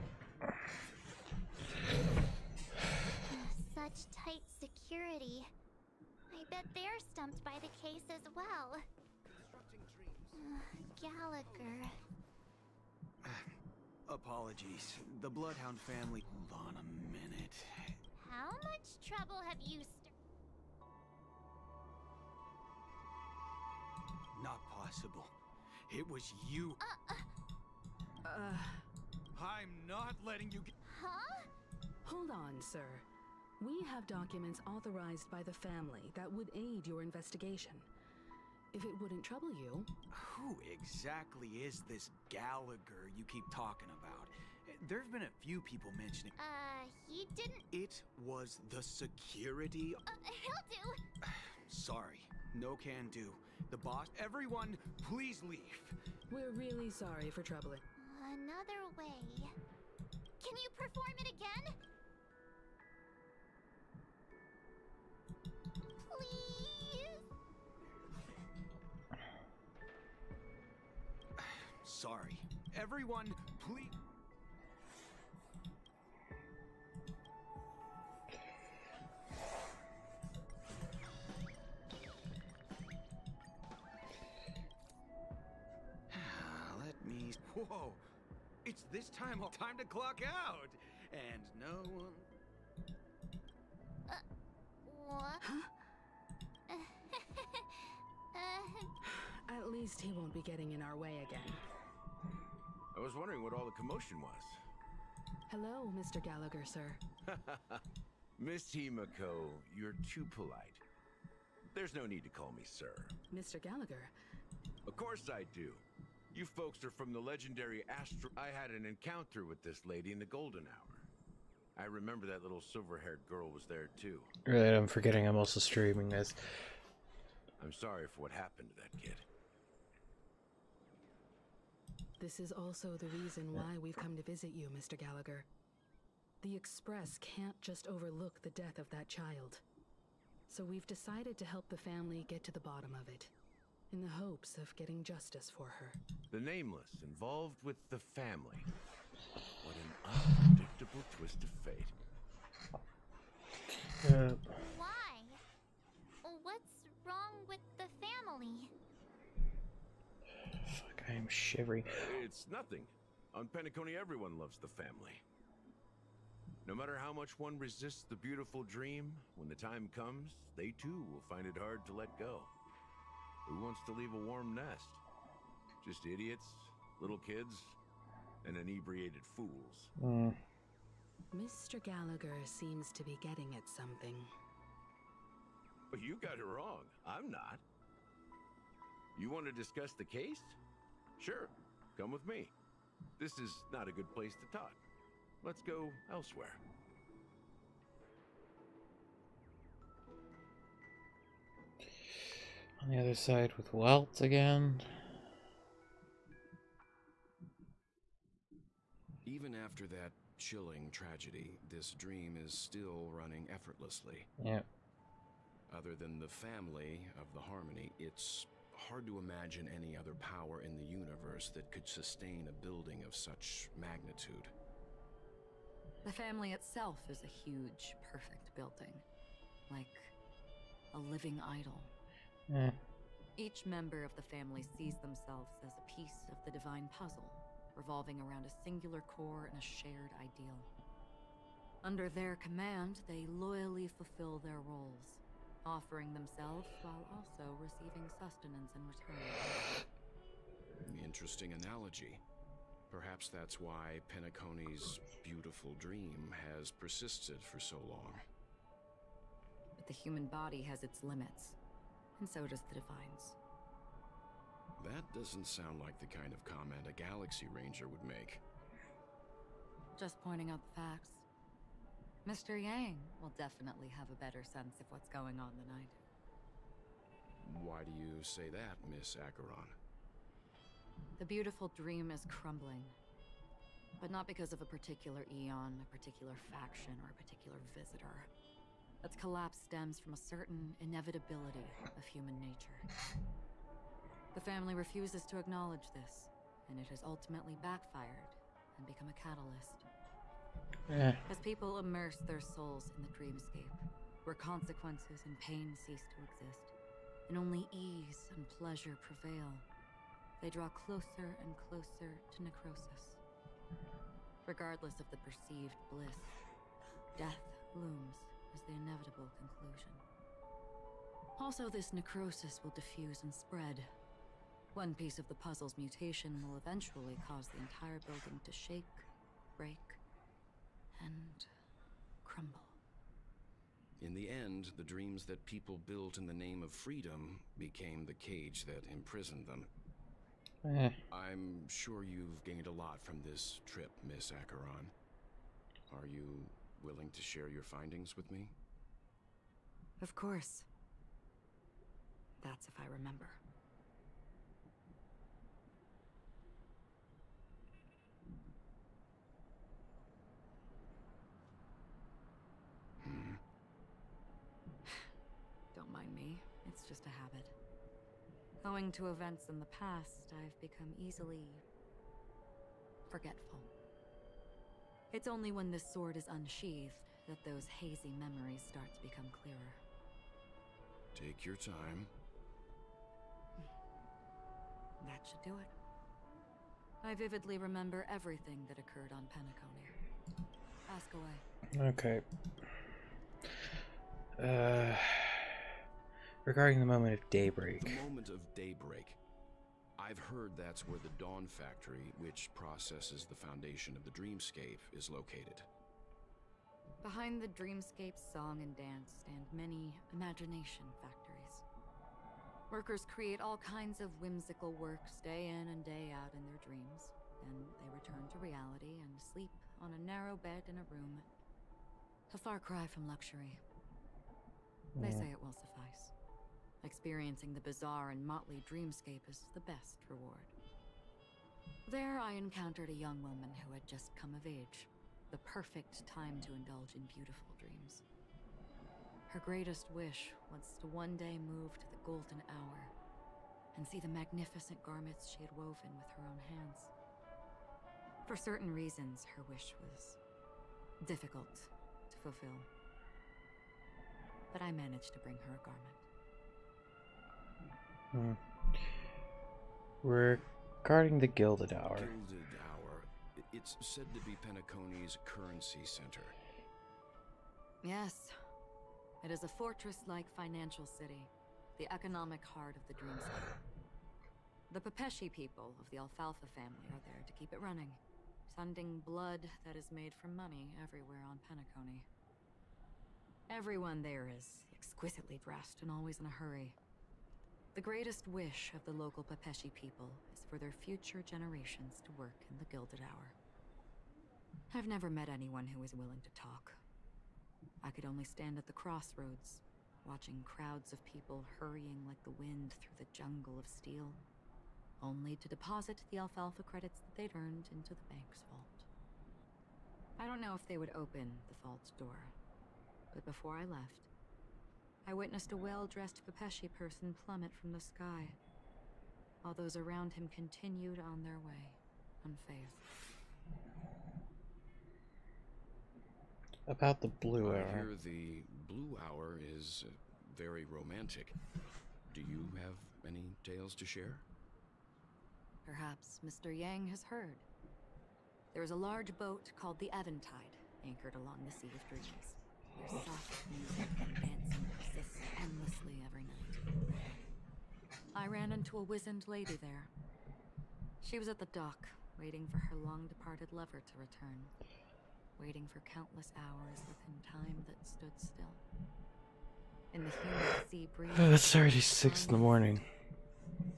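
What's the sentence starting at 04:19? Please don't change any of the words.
But the human body has its limits and so does the Divines.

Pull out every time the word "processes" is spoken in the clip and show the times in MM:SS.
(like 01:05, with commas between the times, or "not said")
06:42.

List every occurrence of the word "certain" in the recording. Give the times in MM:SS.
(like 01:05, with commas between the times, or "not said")
04:50, 07:28.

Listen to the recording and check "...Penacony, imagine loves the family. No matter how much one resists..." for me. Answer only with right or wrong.
wrong.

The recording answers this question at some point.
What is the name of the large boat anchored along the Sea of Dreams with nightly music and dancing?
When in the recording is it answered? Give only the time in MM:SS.
08:59.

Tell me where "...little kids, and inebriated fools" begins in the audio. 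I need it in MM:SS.
02:57.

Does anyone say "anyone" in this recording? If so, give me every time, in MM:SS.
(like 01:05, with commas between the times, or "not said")
08:15.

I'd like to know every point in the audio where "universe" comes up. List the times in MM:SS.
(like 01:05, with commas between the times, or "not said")
03:40.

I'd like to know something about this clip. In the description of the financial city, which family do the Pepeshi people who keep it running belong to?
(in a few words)
Alfalfa family.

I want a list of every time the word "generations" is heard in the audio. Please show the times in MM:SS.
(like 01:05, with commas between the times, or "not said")
08:11.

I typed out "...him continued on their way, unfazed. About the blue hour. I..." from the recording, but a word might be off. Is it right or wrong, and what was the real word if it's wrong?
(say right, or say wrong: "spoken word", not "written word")
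right.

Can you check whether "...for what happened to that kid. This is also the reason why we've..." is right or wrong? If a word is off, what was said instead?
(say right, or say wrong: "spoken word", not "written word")
right.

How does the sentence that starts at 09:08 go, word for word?
I ran into a wizened lady there.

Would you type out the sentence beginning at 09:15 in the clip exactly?
Waiting for countless hours within time that stood still.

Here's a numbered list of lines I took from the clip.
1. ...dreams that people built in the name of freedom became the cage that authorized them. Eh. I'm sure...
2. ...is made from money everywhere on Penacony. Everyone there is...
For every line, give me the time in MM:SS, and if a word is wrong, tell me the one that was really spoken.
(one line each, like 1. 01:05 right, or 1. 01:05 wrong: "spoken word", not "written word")
1. 05:34 wrong: "imprisoned", not "authorized"
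2. 07:59 right.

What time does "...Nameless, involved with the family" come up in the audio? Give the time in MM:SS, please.
02:26.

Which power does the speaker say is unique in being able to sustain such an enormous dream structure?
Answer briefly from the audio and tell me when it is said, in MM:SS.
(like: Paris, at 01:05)
the family of the Harmony, at 03:36.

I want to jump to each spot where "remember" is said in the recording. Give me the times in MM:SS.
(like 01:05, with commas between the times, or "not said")
02:01, 05:52, 06:27.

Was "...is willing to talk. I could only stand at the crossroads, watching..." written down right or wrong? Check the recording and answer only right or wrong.
right.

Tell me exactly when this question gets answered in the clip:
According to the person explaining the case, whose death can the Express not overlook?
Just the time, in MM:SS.
02:18.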